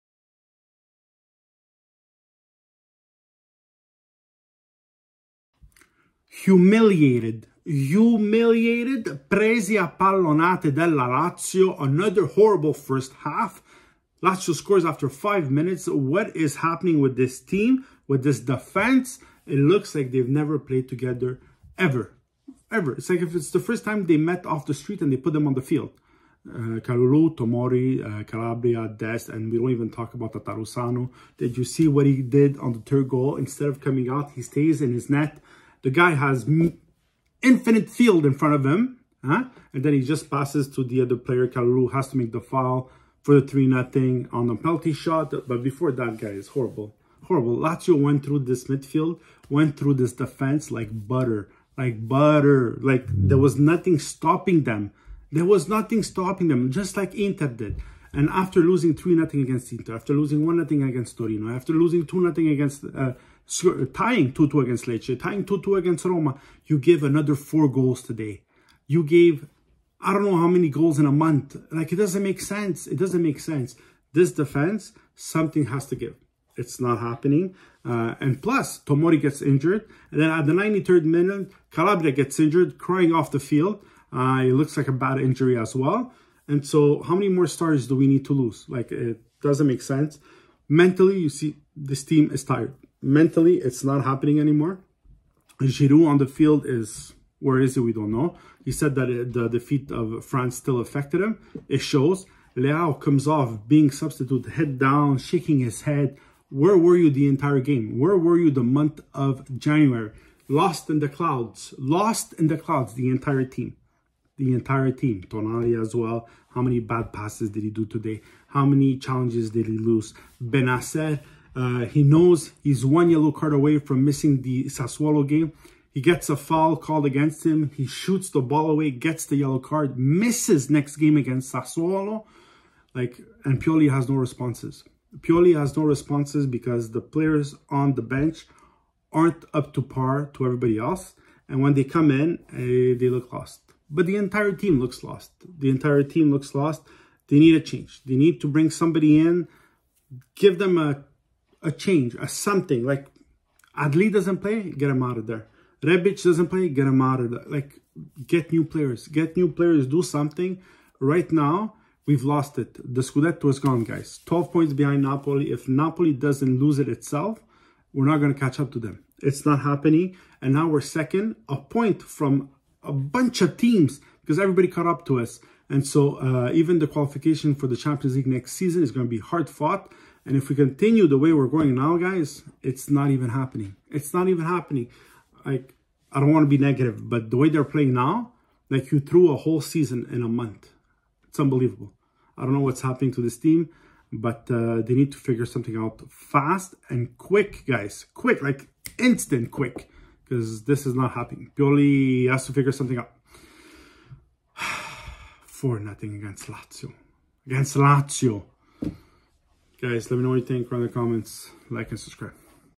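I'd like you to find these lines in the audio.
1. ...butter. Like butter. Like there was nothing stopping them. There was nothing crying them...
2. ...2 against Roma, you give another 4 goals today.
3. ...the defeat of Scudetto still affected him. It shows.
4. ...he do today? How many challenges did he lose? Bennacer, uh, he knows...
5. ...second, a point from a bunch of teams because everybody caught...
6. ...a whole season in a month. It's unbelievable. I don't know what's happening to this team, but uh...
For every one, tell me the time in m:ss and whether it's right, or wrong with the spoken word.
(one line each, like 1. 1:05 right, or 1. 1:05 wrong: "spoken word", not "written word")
1. 0:51 wrong: "stopping", not "crying"
2. 1:05 right
3. 1:39 wrong: "France", not "Scudetto"
4. 1:57 right
5. 2:50 right
6. 3:09 right.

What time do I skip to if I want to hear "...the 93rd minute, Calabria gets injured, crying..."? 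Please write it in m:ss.
1:20.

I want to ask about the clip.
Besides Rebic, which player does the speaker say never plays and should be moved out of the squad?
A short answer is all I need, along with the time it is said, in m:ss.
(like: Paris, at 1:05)
Adli, at 2:33.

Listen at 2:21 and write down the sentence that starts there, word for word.
And when they come in, uh, they look lost but the entire team looks lost.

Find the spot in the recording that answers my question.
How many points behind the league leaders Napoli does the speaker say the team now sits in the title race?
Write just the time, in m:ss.
2:44.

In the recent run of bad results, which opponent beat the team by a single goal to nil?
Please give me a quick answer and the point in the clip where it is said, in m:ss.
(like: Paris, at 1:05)
Torino, at 1:01.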